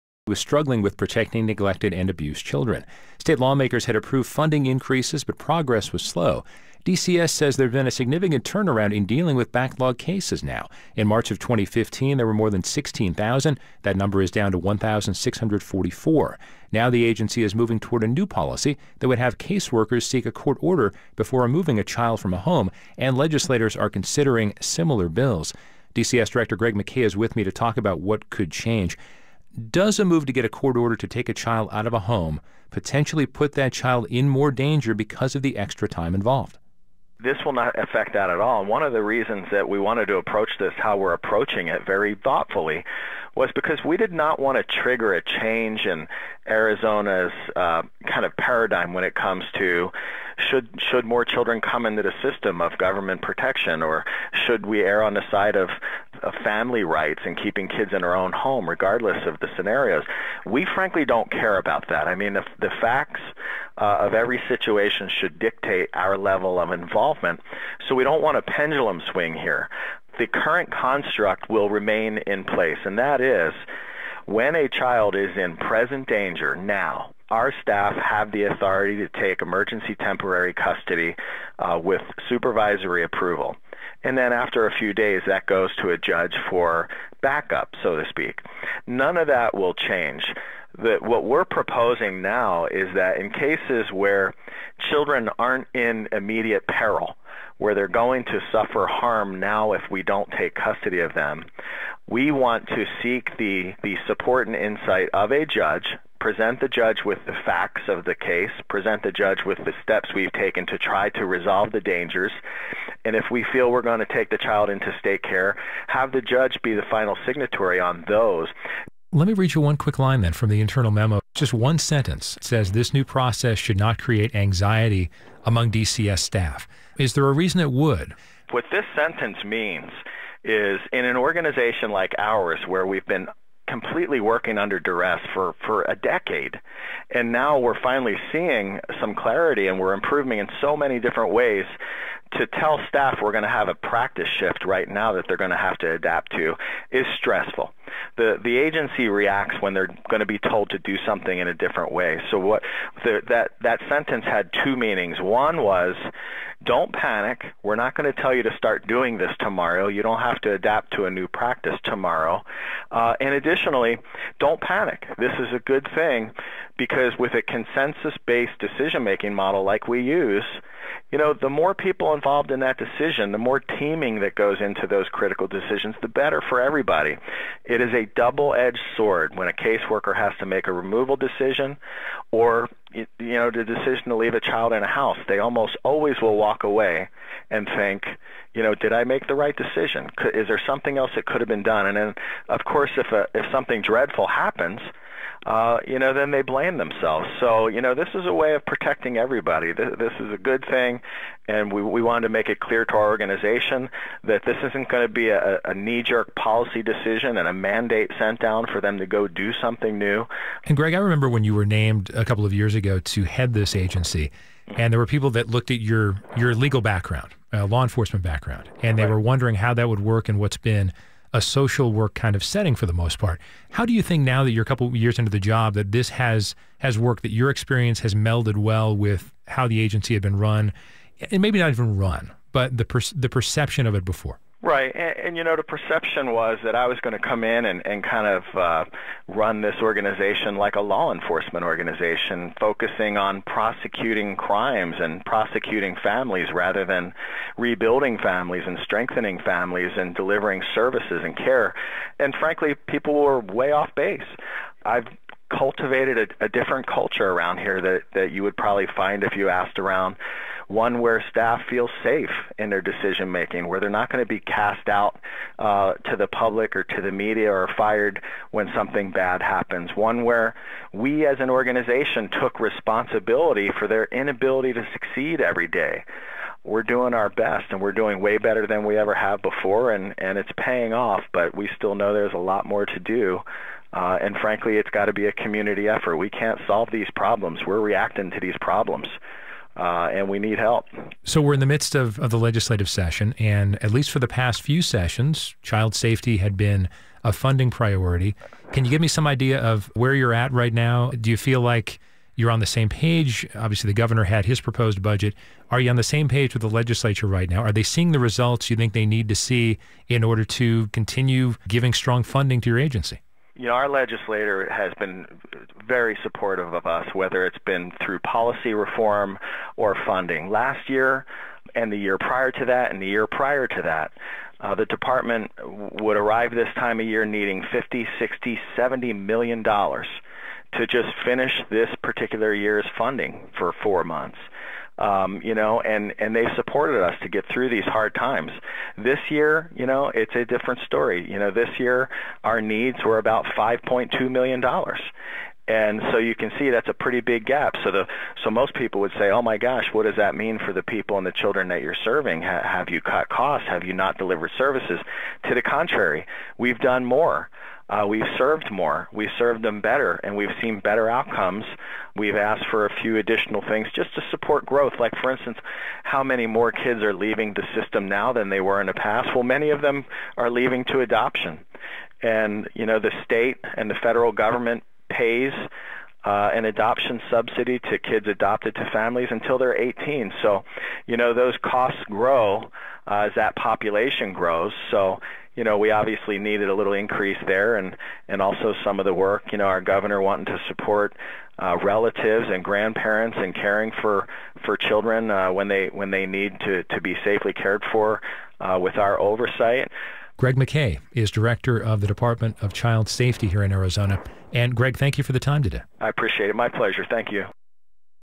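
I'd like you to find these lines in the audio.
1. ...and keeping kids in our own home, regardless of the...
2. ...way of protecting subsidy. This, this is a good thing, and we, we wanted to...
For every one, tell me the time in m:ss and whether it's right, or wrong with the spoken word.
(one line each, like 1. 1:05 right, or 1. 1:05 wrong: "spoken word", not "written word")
1. 0:57 right
2. 3:18 wrong: "everybody", not "subsidy".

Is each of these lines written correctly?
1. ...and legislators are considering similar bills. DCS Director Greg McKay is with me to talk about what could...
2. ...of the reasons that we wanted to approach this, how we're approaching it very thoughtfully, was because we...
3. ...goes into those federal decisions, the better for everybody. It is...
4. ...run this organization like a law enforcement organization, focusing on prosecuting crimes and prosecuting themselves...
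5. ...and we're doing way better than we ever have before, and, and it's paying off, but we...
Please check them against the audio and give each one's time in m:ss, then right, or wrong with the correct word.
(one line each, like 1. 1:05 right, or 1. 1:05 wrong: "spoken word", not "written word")
1. 0:22 right
2. 0:38 right
3. 2:54 wrong: "critical", not "federal"
4. 3:59 wrong: "families", not "themselves"
5. 4:37 right.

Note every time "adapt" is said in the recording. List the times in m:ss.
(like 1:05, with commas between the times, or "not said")
2:25, 2:40.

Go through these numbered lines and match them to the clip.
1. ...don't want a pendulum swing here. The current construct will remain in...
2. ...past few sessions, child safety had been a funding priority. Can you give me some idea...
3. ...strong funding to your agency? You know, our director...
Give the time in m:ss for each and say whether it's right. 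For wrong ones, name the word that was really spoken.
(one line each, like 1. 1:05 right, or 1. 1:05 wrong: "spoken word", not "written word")
1. 1:08 right
2. 4:54 right
3. 5:11 wrong: "legislator", not "director".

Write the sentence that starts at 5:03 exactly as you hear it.
Obviously, the governor had his proposed budget.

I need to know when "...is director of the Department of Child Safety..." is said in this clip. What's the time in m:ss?
6:41.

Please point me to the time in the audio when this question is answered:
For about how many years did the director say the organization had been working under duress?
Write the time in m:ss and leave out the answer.
2:15.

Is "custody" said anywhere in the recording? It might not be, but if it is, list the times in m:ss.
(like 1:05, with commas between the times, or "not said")
1:20, 1:40.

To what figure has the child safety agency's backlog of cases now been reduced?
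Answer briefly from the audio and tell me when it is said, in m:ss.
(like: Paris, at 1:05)
1,644, at 0:14.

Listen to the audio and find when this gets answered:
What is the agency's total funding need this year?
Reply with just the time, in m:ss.
5:43.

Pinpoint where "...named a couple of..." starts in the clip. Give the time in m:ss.
3:31.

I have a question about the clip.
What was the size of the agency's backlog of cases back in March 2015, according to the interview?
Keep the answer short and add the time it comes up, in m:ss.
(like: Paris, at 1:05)
more than 16,000, at 0:12.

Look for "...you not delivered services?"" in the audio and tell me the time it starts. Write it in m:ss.
5:53.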